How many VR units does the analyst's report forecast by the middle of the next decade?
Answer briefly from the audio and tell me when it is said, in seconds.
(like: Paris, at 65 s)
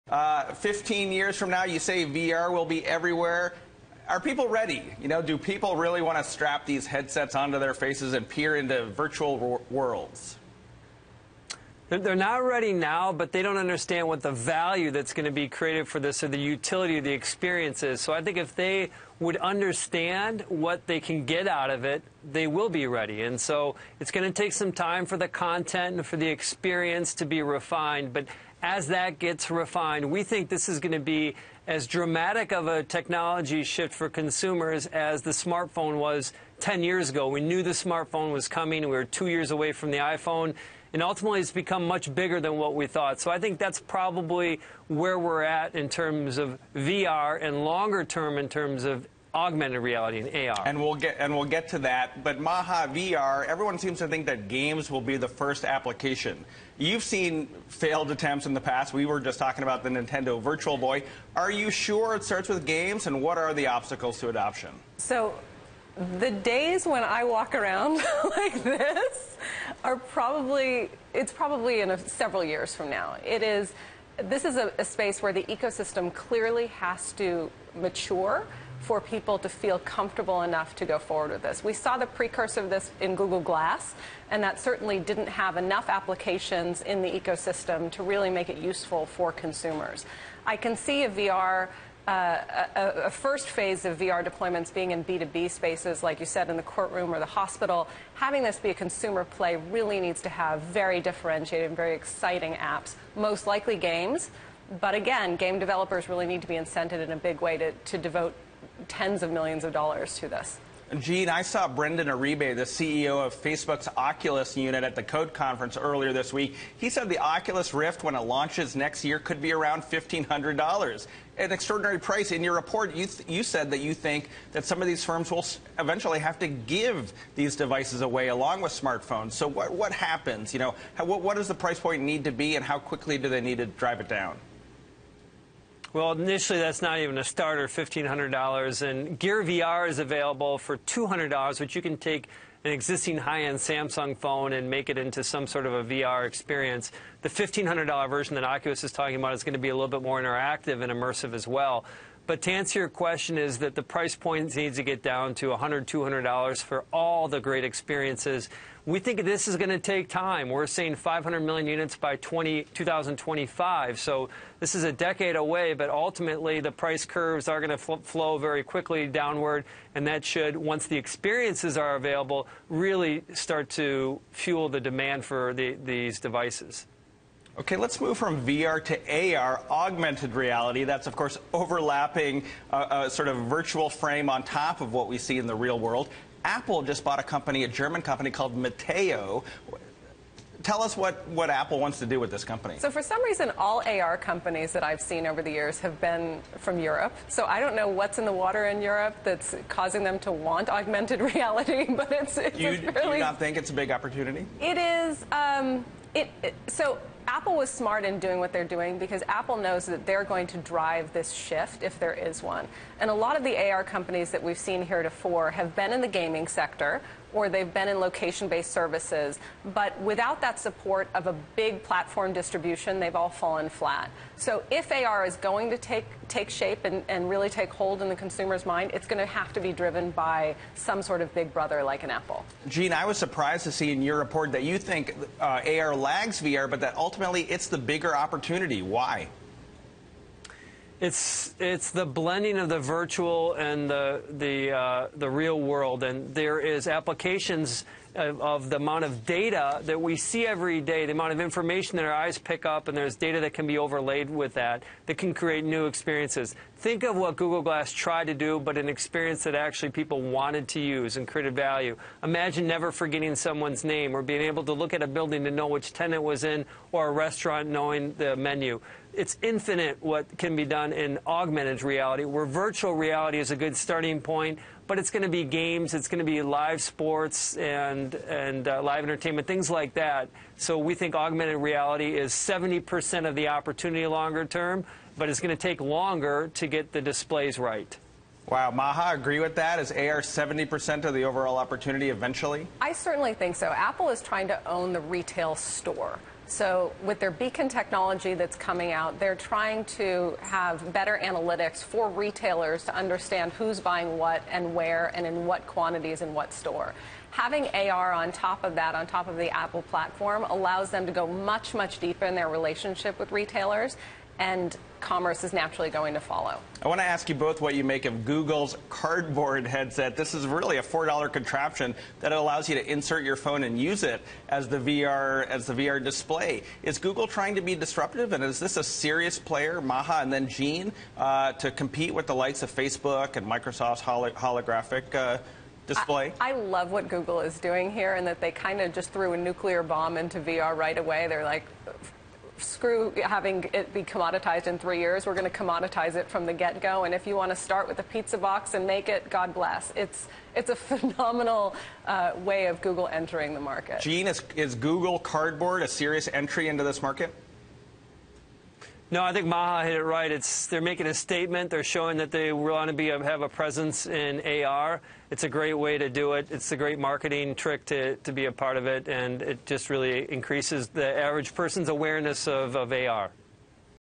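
500 million, at 160 s.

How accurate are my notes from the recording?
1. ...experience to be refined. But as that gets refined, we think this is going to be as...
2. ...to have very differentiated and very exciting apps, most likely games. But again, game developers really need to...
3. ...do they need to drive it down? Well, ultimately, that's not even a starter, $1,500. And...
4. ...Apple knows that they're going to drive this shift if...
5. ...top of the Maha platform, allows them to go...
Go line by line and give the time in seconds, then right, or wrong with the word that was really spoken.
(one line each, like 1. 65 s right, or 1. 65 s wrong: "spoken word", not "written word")
1. 26 s right
2. 100 s right
3. 133 s wrong: "initially", not "ultimately"
4. 209 s right
5. 309 s wrong: "Apple", not "Maha".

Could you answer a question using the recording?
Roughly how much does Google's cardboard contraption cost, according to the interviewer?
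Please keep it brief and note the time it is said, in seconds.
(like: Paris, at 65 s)
$4, at 320 s.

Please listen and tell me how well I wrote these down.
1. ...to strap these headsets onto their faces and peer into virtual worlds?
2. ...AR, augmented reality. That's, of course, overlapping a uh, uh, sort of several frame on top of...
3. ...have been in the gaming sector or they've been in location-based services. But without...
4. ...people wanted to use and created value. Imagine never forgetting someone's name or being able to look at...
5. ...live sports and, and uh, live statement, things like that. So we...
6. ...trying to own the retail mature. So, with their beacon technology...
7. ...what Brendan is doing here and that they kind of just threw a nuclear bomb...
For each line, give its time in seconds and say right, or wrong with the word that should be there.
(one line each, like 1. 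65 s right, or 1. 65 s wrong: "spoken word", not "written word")
1. 6 s right
2. 179 s wrong: "virtual", not "several"
3. 215 s right
4. 259 s right
5. 276 s wrong: "entertainment", not "statement"
6. 294 s wrong: "store", not "mature"
7. 336 s wrong: "Google", not "Brendan".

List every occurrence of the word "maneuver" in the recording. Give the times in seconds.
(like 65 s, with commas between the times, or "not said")
not said.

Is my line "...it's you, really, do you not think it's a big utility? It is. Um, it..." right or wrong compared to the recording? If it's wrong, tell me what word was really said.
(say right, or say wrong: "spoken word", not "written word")
wrong: "opportunity", not "utility".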